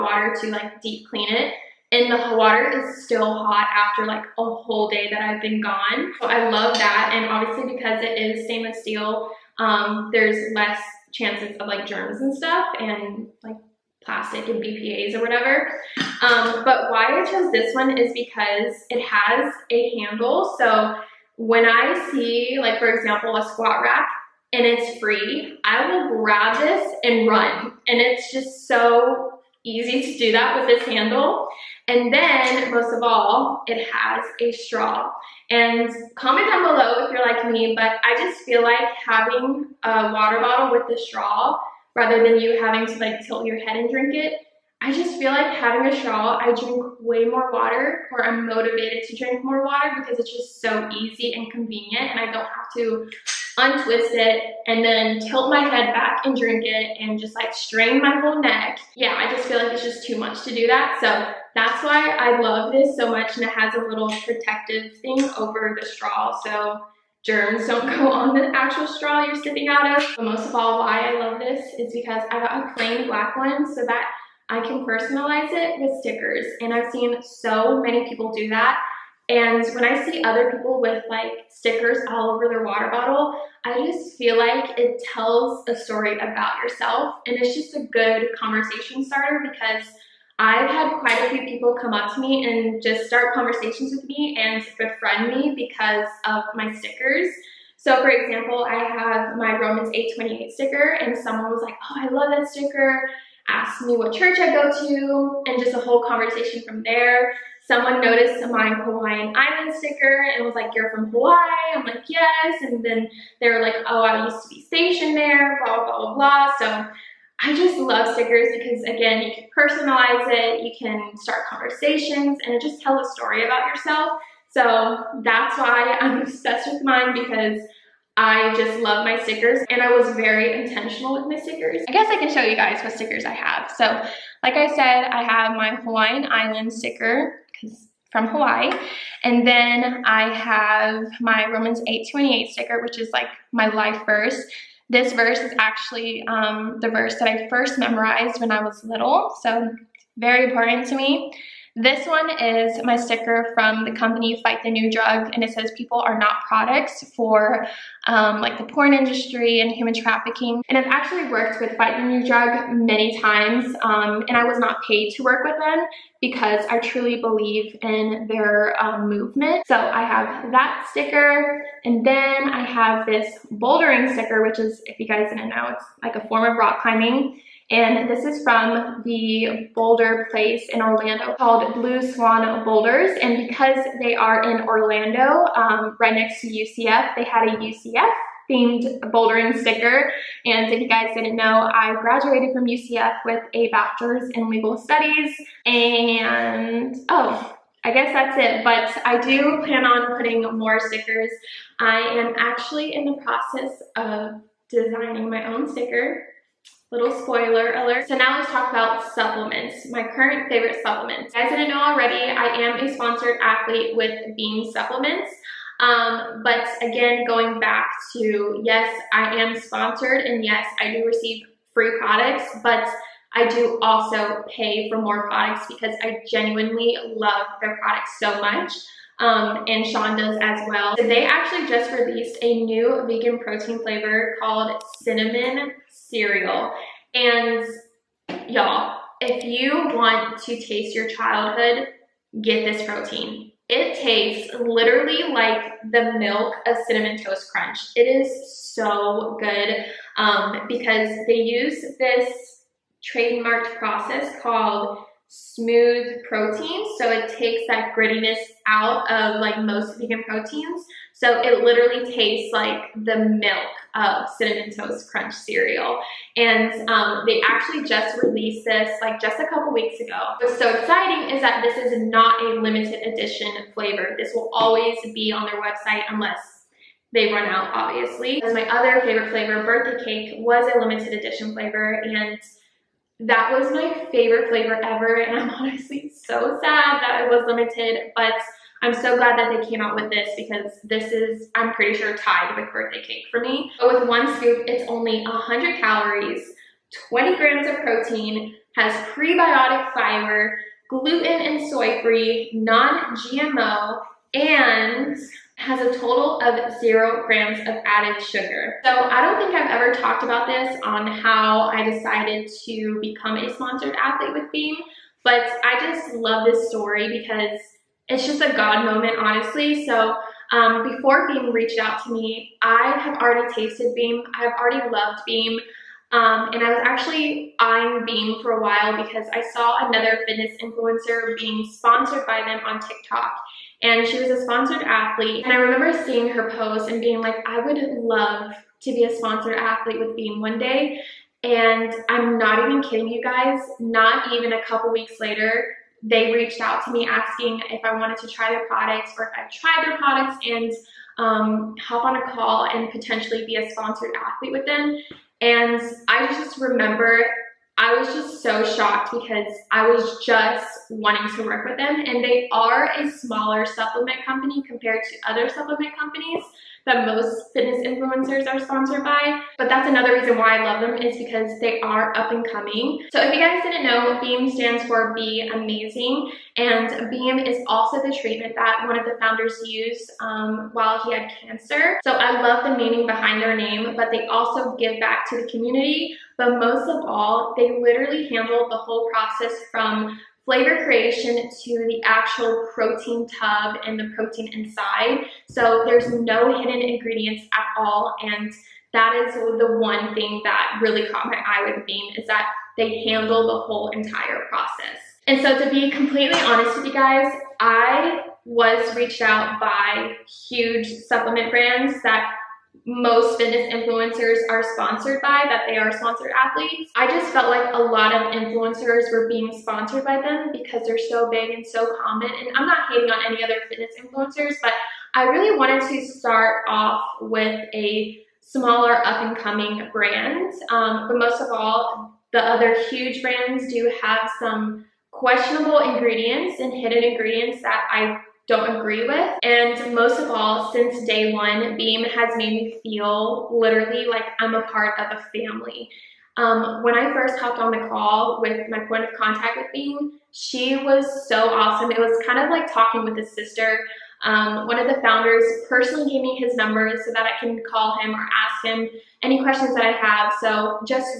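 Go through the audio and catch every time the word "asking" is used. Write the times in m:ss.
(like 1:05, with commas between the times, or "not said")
5:47.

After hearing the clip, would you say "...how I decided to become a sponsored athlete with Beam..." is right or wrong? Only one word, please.
right.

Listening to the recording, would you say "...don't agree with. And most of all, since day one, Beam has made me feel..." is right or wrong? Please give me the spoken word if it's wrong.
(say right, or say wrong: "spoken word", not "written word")
right.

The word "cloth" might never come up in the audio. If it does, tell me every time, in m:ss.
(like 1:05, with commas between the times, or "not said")
not said.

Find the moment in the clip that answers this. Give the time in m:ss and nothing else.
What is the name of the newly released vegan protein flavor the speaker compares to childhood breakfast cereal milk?
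3:55.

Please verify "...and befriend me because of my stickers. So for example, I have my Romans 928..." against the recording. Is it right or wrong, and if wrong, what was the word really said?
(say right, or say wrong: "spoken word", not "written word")
wrong: "828", not "928".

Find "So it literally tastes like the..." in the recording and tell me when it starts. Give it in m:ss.
4:21.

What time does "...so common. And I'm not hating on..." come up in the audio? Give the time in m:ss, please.
7:01.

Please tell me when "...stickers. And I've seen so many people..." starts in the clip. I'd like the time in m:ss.
1:16.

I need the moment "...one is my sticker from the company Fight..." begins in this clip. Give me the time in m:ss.
2:32.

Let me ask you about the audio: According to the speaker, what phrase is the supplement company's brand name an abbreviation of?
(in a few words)
Be Amazing.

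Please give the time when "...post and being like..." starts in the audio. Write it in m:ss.
5:36.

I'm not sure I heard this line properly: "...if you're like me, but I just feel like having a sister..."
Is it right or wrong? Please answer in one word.
wrong.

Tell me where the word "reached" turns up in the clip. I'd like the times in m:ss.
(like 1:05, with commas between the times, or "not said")
5:21, 5:46, 6:48.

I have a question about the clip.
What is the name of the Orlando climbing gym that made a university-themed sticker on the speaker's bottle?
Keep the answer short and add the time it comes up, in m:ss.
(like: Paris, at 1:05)
Blue Swan Boulders, at 3:01.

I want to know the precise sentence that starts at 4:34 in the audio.
This will always be on their website unless they run out, obviously.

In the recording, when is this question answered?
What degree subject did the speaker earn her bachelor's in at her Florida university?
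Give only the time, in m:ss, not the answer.
3:14.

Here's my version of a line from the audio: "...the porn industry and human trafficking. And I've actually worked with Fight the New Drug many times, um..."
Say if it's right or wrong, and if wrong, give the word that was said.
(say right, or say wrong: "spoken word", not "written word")
right.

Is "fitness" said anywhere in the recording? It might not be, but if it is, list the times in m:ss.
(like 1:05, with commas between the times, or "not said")
5:30, 6:07, 6:53, 7:03.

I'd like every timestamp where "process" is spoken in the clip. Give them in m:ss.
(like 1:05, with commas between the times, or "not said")
3:23, 4:13, 6:29, 6:44.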